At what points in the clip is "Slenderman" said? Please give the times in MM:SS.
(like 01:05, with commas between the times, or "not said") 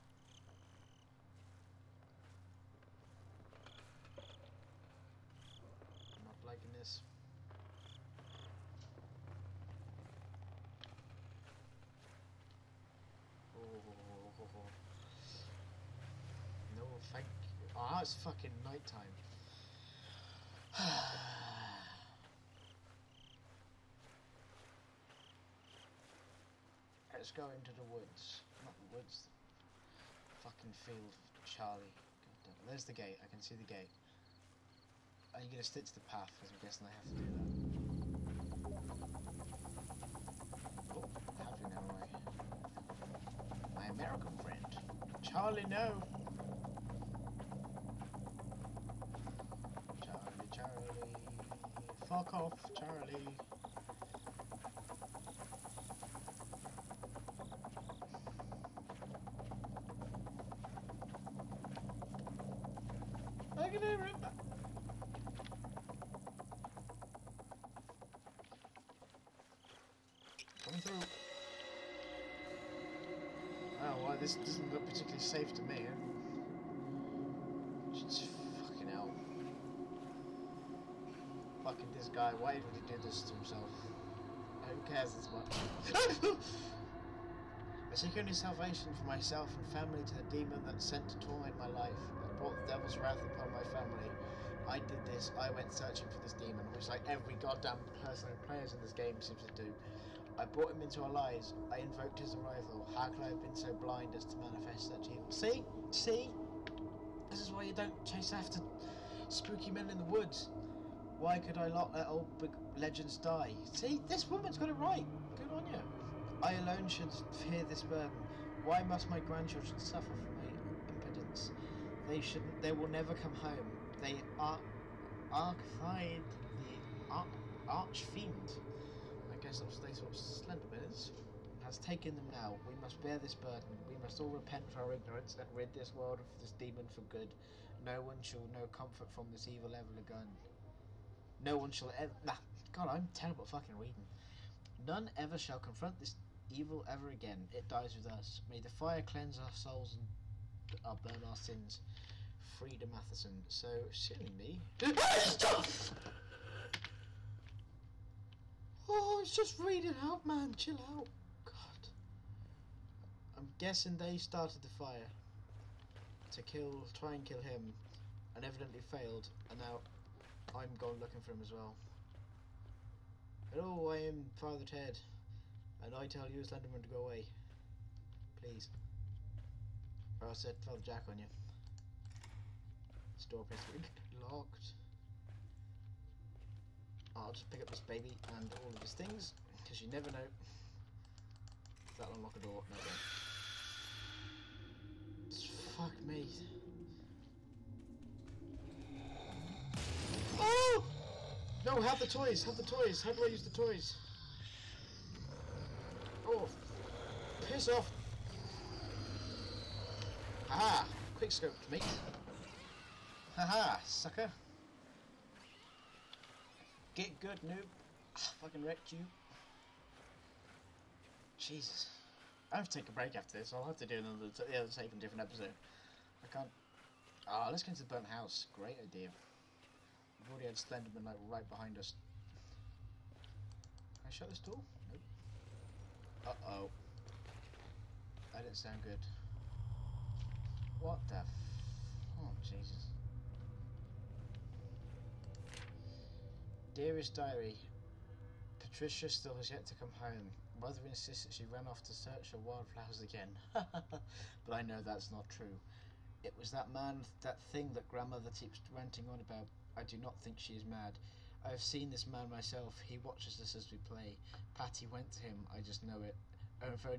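02:56, 03:50.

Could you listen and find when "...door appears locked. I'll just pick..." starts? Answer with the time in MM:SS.
03:03.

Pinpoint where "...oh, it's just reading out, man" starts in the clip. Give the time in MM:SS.
02:38.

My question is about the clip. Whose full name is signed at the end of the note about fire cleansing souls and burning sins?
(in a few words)
Frida Matheson.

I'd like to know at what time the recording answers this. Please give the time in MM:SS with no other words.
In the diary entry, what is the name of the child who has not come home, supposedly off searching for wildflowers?
04:08.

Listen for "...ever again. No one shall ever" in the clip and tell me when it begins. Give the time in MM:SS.
02:19.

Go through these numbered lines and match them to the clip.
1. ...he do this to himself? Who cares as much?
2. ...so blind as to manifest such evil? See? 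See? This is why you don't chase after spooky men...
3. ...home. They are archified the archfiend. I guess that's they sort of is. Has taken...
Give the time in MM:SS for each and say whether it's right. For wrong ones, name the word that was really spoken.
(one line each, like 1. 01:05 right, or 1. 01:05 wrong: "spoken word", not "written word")
1. 01:22 right
2. 01:43 right
3. 02:03 right.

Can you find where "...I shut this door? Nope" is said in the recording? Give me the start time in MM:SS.
03:54.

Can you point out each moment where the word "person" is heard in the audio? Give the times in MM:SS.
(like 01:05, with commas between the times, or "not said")
01:38.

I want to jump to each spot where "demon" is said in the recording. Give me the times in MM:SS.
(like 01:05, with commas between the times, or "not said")
01:30, 01:36, 02:16.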